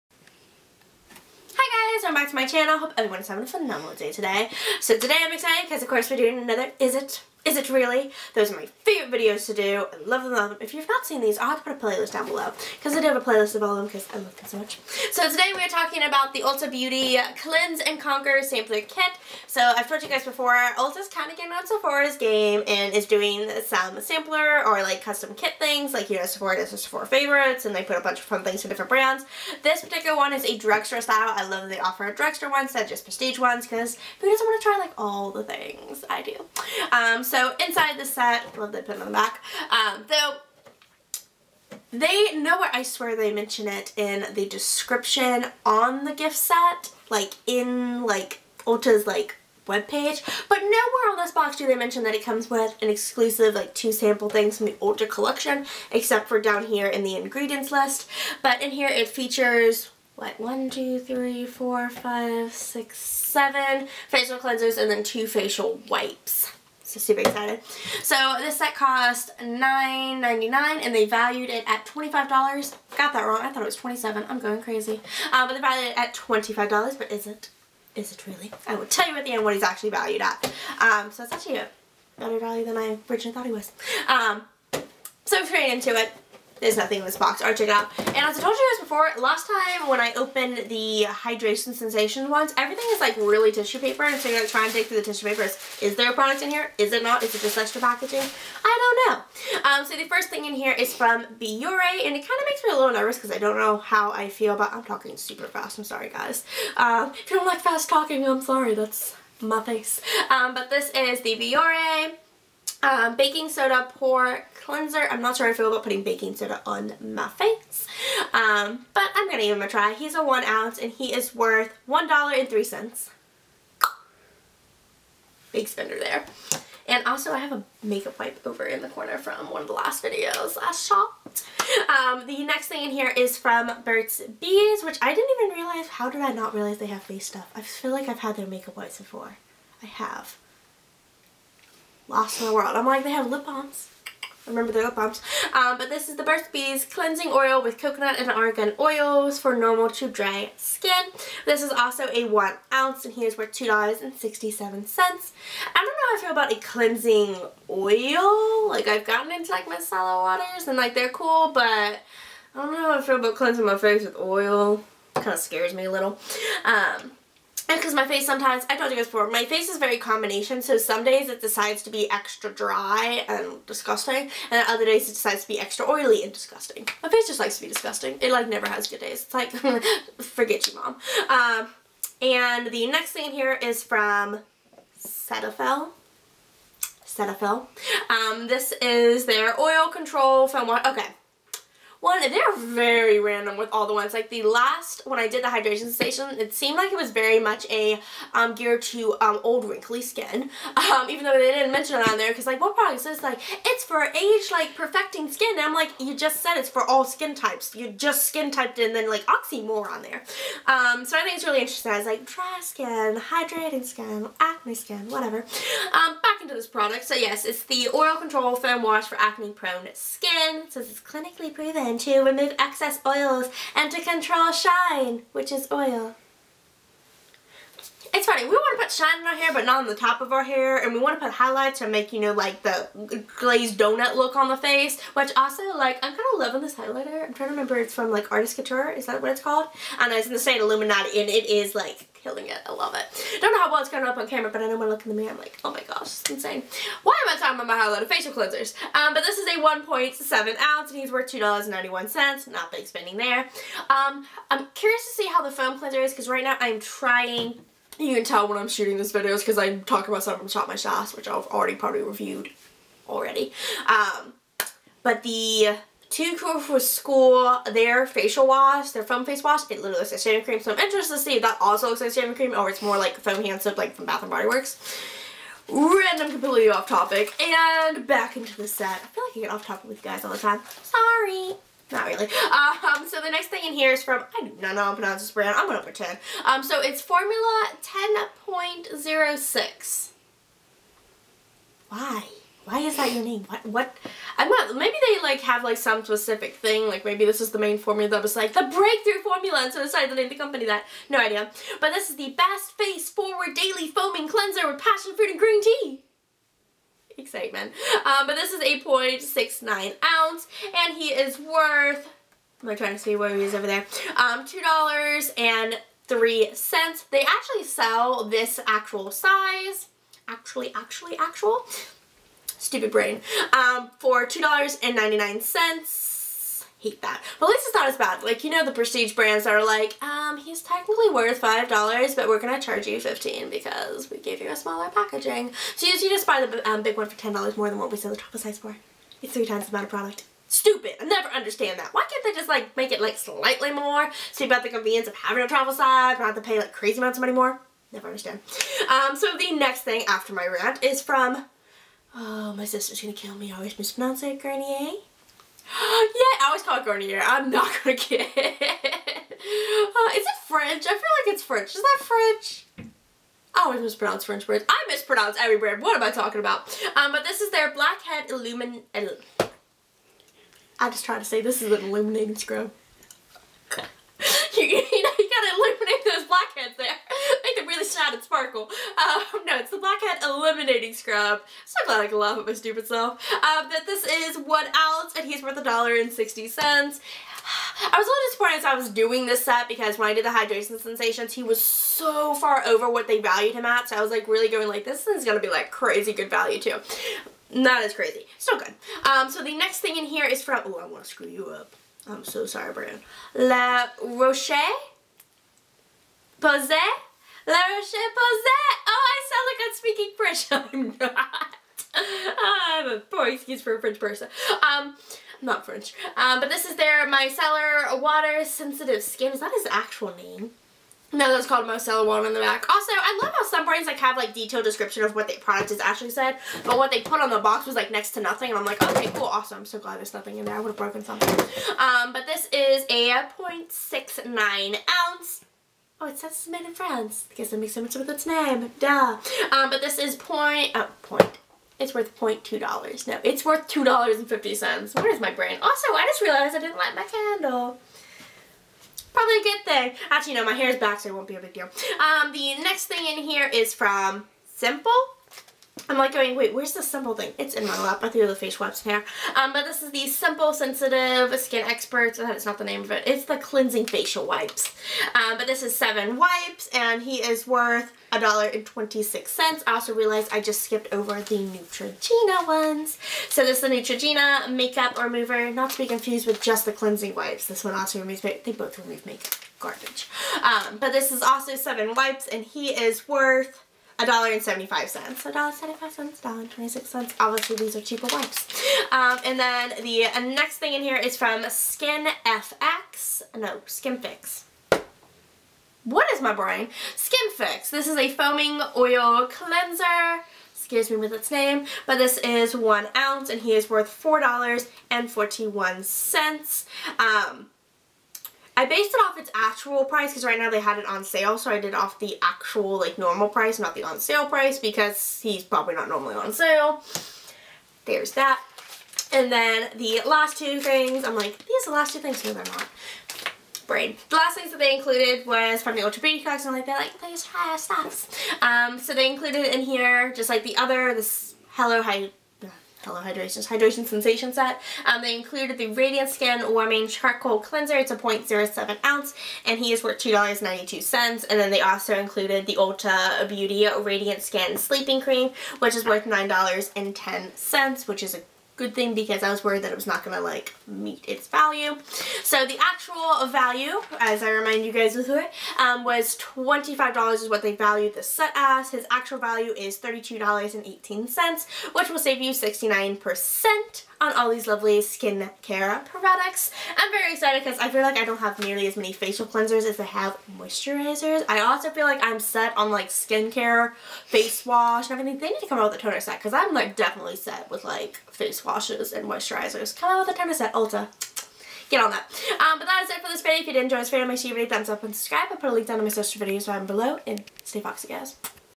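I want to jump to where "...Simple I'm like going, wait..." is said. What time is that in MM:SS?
07:34.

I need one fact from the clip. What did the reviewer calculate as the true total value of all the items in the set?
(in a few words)
$32.18.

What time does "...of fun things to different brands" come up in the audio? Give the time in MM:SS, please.
00:28.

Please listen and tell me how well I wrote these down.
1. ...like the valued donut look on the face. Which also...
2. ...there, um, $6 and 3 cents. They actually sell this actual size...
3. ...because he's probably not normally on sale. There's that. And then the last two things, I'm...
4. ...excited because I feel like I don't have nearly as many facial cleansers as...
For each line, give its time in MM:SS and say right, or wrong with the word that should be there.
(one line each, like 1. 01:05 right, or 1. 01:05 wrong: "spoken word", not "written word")
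1. 03:52 wrong: "glazed", not "valued"
2. 05:13 wrong: "2", not "6"
3. 08:34 right
4. 09:27 right.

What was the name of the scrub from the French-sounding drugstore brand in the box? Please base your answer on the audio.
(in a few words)
Blackhead Eliminating Scrub.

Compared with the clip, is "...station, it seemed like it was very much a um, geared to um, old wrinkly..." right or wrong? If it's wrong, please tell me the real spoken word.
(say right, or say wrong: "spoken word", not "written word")
right.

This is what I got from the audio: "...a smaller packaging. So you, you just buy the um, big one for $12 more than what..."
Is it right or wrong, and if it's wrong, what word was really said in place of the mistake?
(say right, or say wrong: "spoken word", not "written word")
wrong: "10", not "12".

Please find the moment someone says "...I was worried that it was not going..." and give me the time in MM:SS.
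09:09.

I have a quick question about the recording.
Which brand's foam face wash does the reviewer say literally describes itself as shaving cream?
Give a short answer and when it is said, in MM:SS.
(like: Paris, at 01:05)
Too Cool for School, at 04:26.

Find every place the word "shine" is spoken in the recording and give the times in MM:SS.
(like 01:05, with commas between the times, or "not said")
03:44, 03:48.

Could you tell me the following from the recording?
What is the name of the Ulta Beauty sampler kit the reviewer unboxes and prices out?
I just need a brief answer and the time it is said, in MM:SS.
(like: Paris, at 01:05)
Cleanse and Conquer, at 00:17.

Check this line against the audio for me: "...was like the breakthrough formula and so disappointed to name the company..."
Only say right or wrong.
wrong.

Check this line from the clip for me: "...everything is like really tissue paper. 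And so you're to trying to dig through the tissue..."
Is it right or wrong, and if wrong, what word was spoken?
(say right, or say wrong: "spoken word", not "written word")
right.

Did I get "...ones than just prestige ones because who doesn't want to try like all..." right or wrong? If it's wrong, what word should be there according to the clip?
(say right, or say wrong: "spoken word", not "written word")
right.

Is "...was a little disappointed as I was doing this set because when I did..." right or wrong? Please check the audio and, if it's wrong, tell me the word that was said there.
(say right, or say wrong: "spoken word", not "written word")
right.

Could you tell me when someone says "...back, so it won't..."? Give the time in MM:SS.
07:30.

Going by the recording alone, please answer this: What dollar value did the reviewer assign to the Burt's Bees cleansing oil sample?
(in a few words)
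$2.67.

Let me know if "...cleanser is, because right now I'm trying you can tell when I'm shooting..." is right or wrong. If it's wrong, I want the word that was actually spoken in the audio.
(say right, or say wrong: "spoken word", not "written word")
right.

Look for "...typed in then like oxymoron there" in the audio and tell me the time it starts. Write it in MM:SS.
03:28.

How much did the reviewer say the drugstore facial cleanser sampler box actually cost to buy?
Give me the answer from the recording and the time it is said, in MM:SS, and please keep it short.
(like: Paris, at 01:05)
$9.99, at 01:09.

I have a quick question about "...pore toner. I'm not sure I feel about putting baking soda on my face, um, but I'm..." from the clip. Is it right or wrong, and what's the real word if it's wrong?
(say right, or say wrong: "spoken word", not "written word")
wrong: "cleanser", not "toner".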